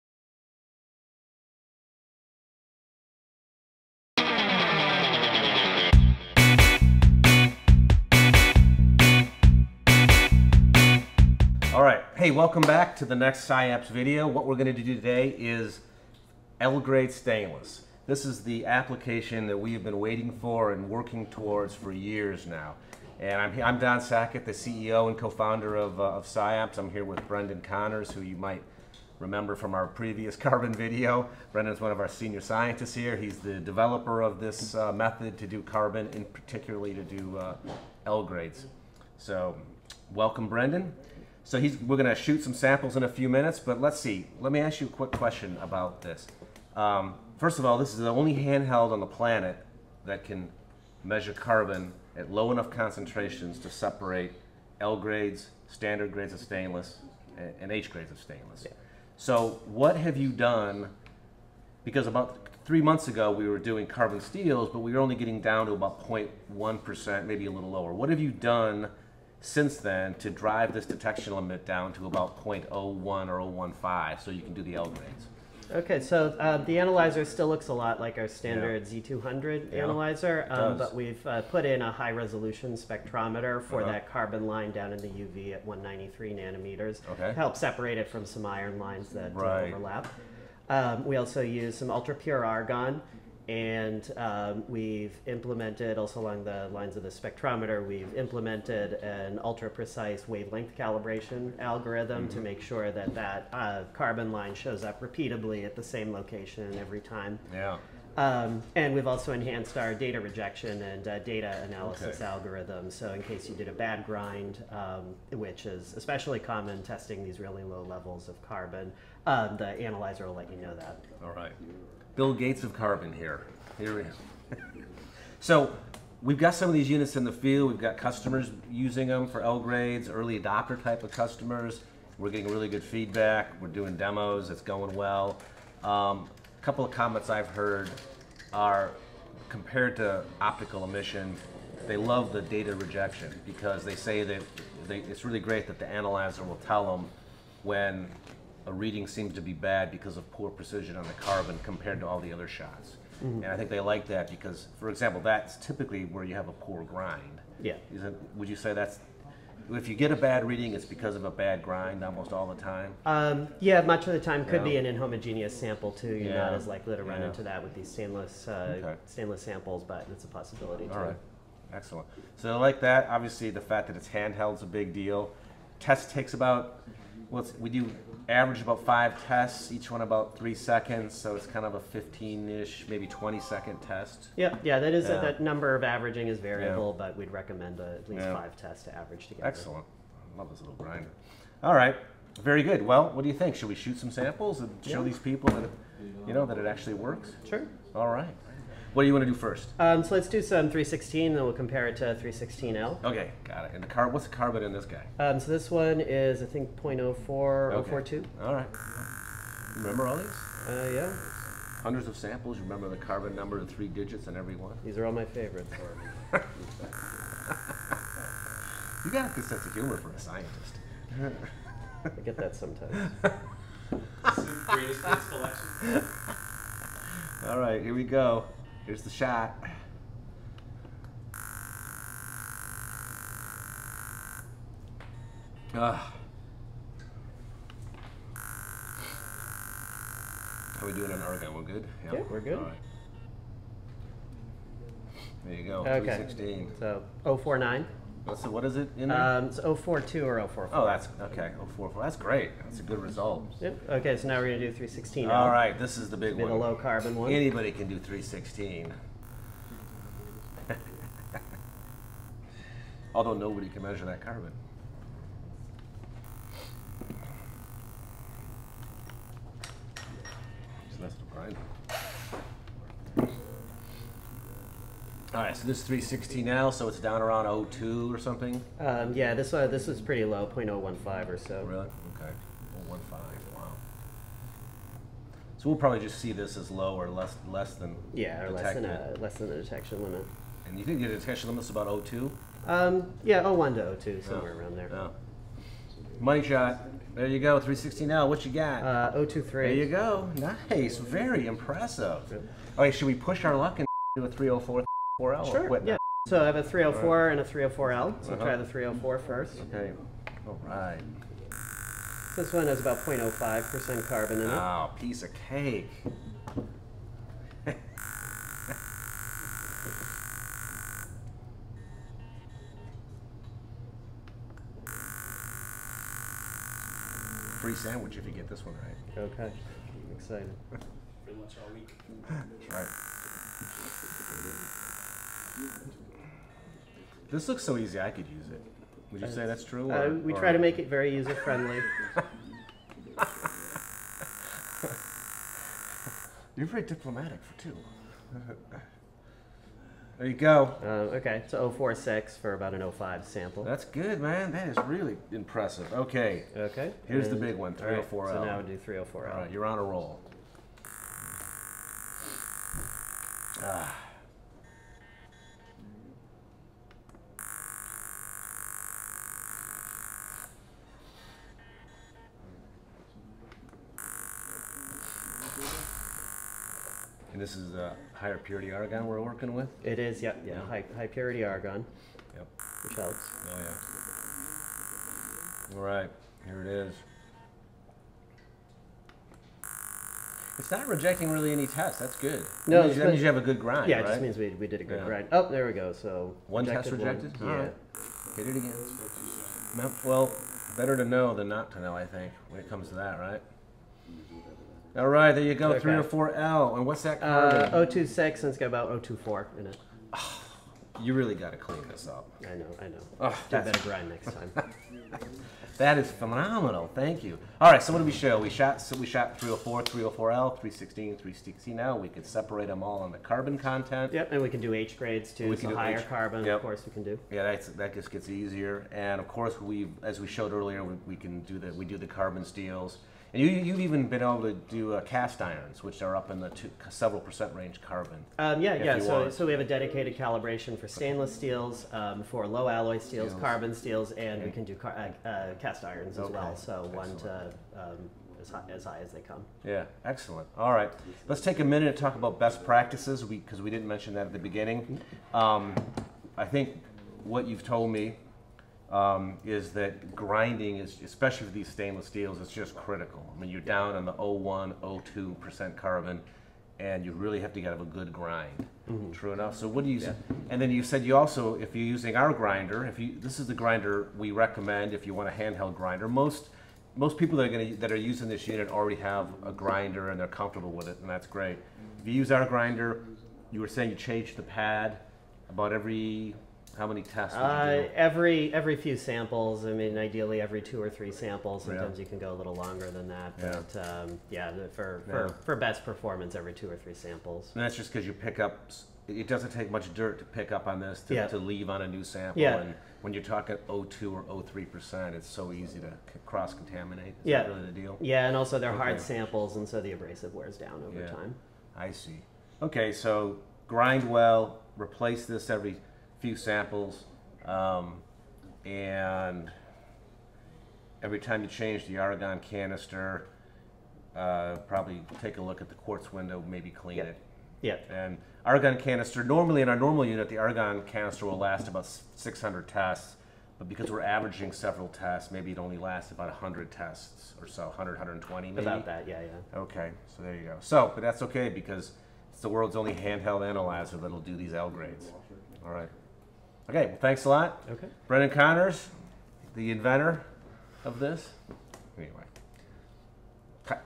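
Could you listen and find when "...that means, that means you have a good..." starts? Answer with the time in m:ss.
6:32.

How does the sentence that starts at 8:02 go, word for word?
If you use our grinder, you were saying you change the pad about every how many tests?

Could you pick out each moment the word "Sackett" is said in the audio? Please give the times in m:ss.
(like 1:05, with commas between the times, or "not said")
0:23.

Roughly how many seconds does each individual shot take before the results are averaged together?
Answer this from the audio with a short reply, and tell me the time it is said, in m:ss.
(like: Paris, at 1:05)
3 seconds, at 3:00.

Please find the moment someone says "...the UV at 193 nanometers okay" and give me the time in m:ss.
1:24.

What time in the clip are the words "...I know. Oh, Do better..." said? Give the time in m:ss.
6:52.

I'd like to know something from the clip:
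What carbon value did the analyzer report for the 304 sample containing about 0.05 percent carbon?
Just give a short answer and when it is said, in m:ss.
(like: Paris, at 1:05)
046, at 5:51.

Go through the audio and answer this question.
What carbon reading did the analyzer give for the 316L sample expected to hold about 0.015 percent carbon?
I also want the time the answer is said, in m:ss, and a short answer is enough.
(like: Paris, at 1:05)
023, at 4:59.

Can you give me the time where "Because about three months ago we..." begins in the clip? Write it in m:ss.
1:01.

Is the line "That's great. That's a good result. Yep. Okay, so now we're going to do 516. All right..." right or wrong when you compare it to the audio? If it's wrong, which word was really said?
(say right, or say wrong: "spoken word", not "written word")
wrong: "316", not "516".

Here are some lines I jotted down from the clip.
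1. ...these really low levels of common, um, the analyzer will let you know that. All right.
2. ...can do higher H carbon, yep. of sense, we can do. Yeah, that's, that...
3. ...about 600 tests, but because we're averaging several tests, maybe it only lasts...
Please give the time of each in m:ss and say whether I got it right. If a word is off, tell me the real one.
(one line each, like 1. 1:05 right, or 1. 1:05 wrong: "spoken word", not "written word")
1. 1:57 wrong: "carbon", not "common"
2. 7:05 wrong: "course", not "sense"
3. 8:51 right.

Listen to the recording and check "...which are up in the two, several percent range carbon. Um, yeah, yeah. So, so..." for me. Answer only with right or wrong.
right.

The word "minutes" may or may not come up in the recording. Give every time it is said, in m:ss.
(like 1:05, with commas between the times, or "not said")
0:43, 7:31.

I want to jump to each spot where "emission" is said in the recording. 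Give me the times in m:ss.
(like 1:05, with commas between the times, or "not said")
2:20.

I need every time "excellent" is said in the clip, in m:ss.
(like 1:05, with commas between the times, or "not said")
2:51, 3:09, 7:30.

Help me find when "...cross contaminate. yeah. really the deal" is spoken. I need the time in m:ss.
8:26.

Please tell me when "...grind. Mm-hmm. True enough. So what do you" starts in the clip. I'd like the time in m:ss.
7:48.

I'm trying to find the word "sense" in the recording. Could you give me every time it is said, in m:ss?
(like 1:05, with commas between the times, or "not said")
3:39.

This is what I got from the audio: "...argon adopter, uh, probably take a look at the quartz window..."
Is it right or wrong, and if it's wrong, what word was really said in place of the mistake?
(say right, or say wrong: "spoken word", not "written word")
wrong: "canister", not "adopter".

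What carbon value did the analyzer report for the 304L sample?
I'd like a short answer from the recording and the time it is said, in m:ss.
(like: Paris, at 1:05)
026, at 6:47.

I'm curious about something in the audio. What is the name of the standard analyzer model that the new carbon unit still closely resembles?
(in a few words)
Z200.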